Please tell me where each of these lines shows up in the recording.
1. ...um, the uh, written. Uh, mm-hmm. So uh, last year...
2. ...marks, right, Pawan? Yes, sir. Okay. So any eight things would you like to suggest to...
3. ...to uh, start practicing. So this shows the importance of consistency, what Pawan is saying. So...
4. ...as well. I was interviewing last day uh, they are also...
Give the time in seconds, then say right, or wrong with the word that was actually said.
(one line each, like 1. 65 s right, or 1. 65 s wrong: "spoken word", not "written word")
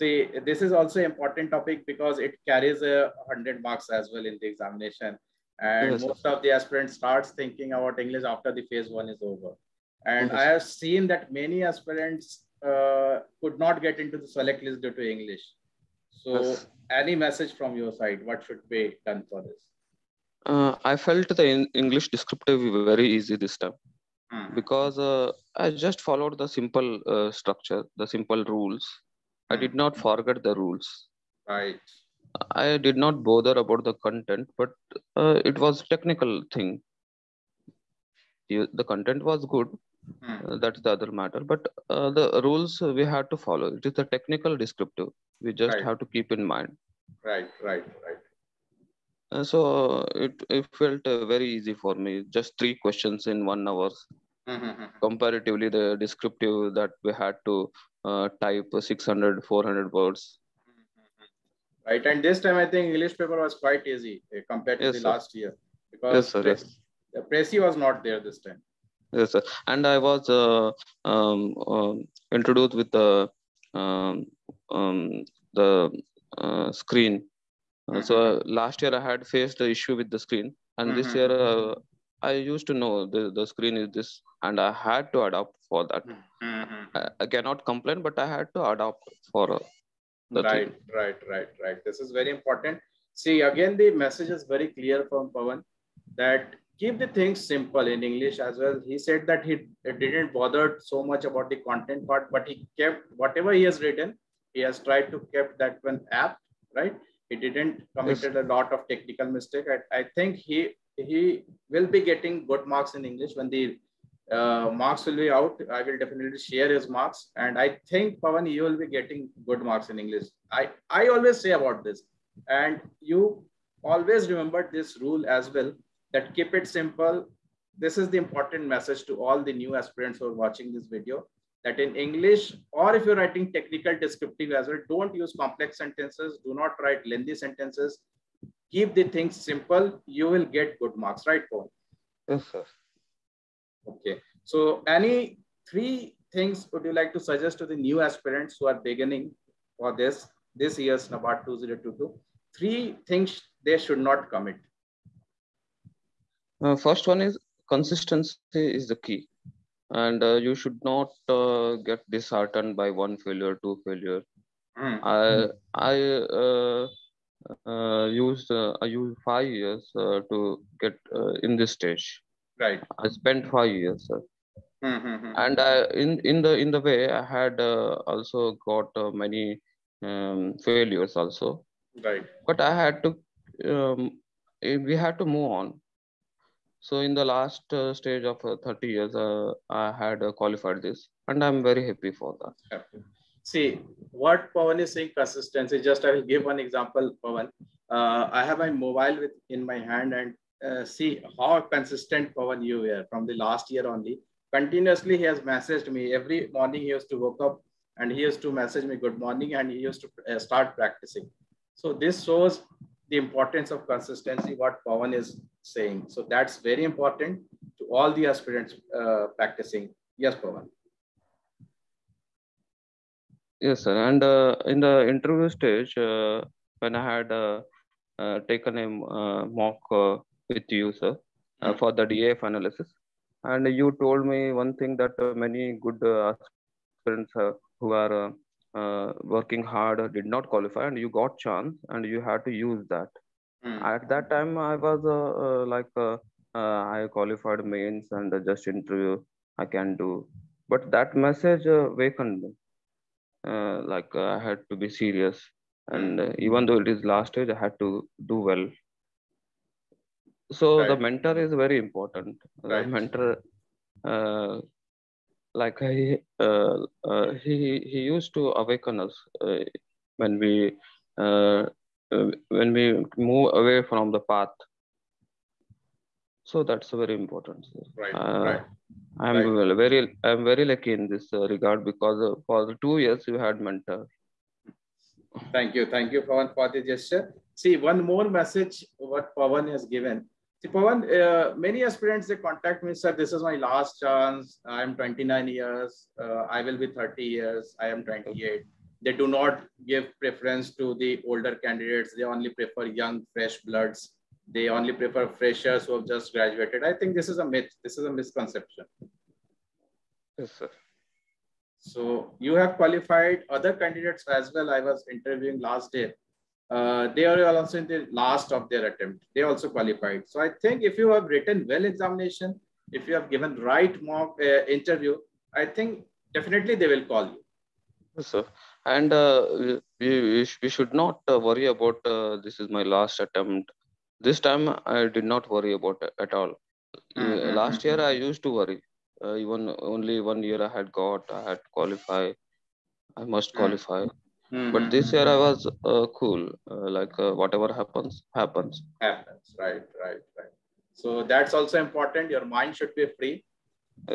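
1. 74 s wrong: "screen", not "written"
2. 140 s wrong: "three", not "eight"
3. 210 s right
4. 314 s right.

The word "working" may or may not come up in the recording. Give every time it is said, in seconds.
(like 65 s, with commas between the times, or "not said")
239 s.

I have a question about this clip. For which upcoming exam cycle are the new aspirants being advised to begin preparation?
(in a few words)
NABARD 2022.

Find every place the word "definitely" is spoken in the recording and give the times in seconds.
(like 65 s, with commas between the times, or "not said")
115 s, 326 s.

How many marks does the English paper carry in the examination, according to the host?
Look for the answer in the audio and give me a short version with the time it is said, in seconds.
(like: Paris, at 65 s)
100, at 2 s.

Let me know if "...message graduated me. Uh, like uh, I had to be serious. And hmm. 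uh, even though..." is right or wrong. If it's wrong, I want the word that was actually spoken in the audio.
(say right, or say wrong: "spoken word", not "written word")
wrong: "awakened", not "graduated".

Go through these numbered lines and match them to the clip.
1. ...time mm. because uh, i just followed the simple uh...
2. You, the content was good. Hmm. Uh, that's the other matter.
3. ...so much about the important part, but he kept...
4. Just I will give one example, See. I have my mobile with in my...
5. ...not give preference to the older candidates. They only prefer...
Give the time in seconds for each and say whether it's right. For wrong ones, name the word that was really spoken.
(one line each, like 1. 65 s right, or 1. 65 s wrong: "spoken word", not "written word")
1. 23 s right
2. 38 s right
3. 100 s wrong: "content", not "important"
4. 195 s wrong: "Pawan", not "See"
5. 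299 s right.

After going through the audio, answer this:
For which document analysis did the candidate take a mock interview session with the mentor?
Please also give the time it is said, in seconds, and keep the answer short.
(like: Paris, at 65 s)
DAF analysis, at 232 s.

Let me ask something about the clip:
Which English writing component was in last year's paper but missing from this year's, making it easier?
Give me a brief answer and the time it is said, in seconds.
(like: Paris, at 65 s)
précis, at 67 s.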